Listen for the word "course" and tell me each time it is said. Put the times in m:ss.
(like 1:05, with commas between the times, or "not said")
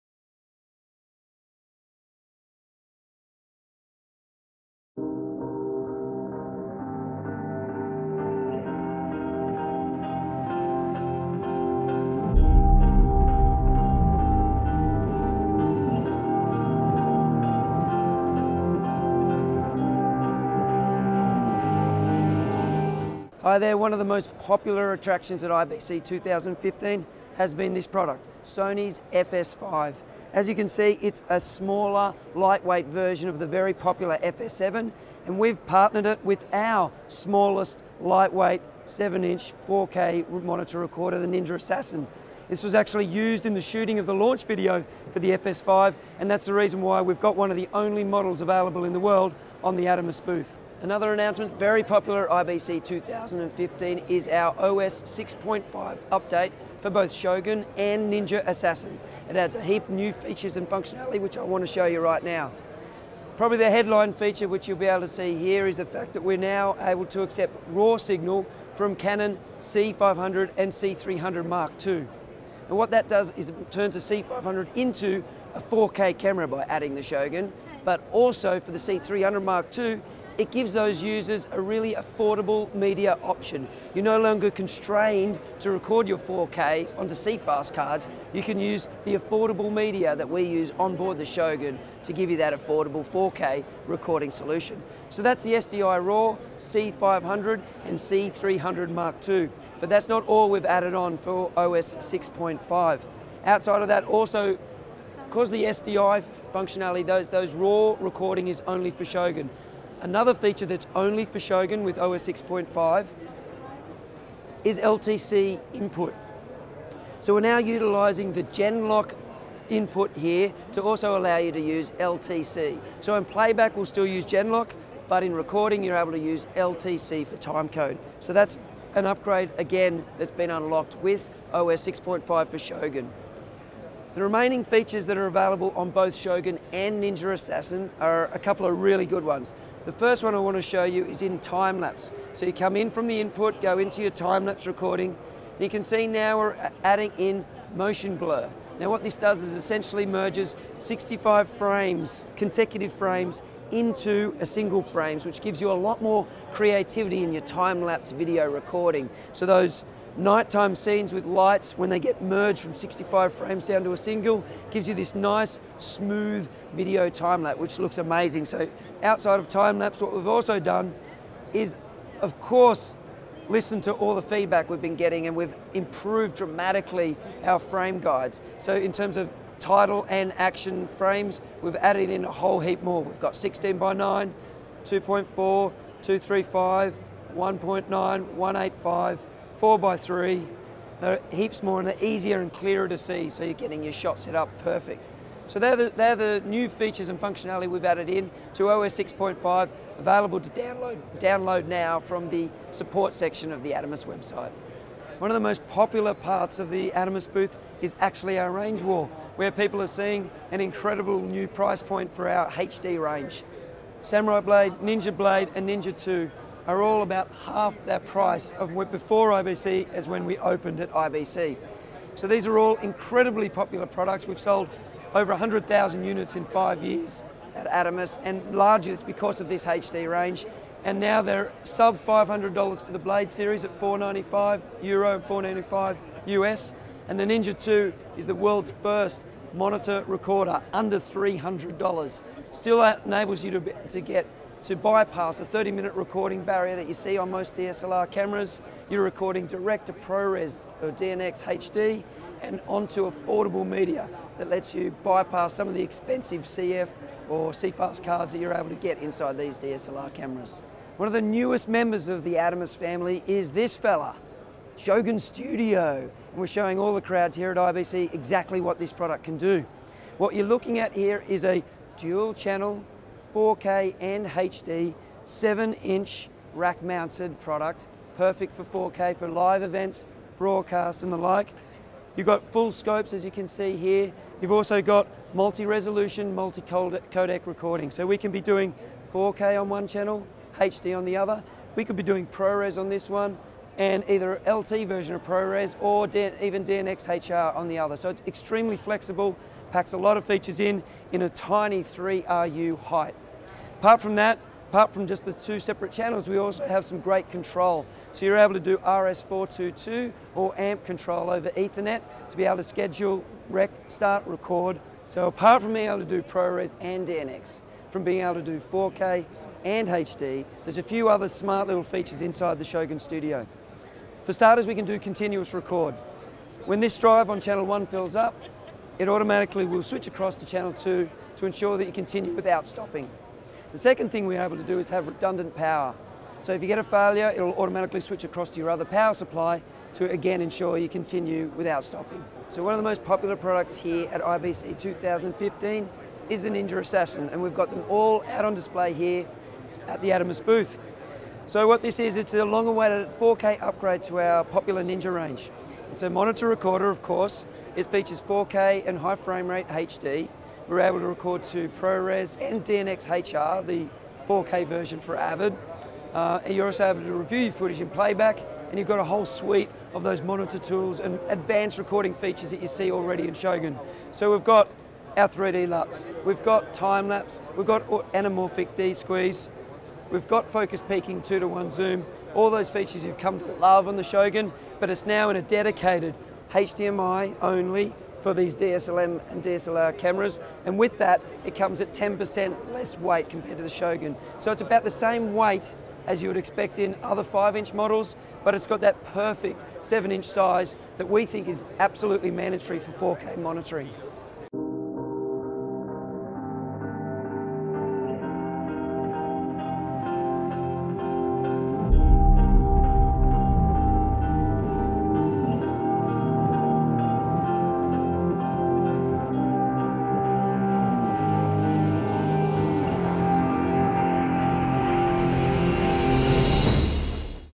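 2:52, 5:57.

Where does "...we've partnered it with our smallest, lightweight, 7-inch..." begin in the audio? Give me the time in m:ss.
0:35.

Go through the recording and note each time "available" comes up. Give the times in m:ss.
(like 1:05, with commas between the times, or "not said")
0:48, 2:15, 3:19.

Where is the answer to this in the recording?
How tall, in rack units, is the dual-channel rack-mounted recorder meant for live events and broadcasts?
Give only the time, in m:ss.
5:01.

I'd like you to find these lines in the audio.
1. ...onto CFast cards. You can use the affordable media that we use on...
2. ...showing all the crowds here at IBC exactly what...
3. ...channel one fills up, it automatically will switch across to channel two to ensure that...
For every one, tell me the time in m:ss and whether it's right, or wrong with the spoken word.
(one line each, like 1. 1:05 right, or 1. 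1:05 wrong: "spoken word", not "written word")
1. 1:26 right
2. 4:26 right
3. 5:27 right.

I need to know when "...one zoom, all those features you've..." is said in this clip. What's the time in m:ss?
6:21.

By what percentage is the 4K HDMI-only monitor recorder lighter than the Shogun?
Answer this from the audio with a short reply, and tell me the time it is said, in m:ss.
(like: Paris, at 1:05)
10%, at 6:31.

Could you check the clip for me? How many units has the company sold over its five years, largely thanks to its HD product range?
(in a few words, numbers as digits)
Over 100,000.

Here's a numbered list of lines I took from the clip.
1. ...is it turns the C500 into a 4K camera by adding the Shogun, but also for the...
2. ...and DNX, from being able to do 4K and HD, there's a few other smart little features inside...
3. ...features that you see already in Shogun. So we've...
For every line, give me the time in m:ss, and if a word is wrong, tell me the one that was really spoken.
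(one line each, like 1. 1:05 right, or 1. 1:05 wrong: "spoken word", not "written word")
1. 1:13 right
2. 5:16 right
3. 6:12 right.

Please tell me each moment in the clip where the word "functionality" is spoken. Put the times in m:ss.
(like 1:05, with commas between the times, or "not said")
1:00, 1:46, 3:17.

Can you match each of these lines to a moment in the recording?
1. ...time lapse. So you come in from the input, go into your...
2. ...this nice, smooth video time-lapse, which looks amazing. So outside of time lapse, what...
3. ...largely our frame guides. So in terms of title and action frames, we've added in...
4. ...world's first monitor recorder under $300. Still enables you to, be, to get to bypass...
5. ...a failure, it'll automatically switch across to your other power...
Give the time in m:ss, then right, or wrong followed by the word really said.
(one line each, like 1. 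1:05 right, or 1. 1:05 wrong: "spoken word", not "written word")
1. 2:21 right
2. 2:44 right
3. 2:56 wrong: "dramatically", not "largely"
4. 3:58 right
5. 5:36 right.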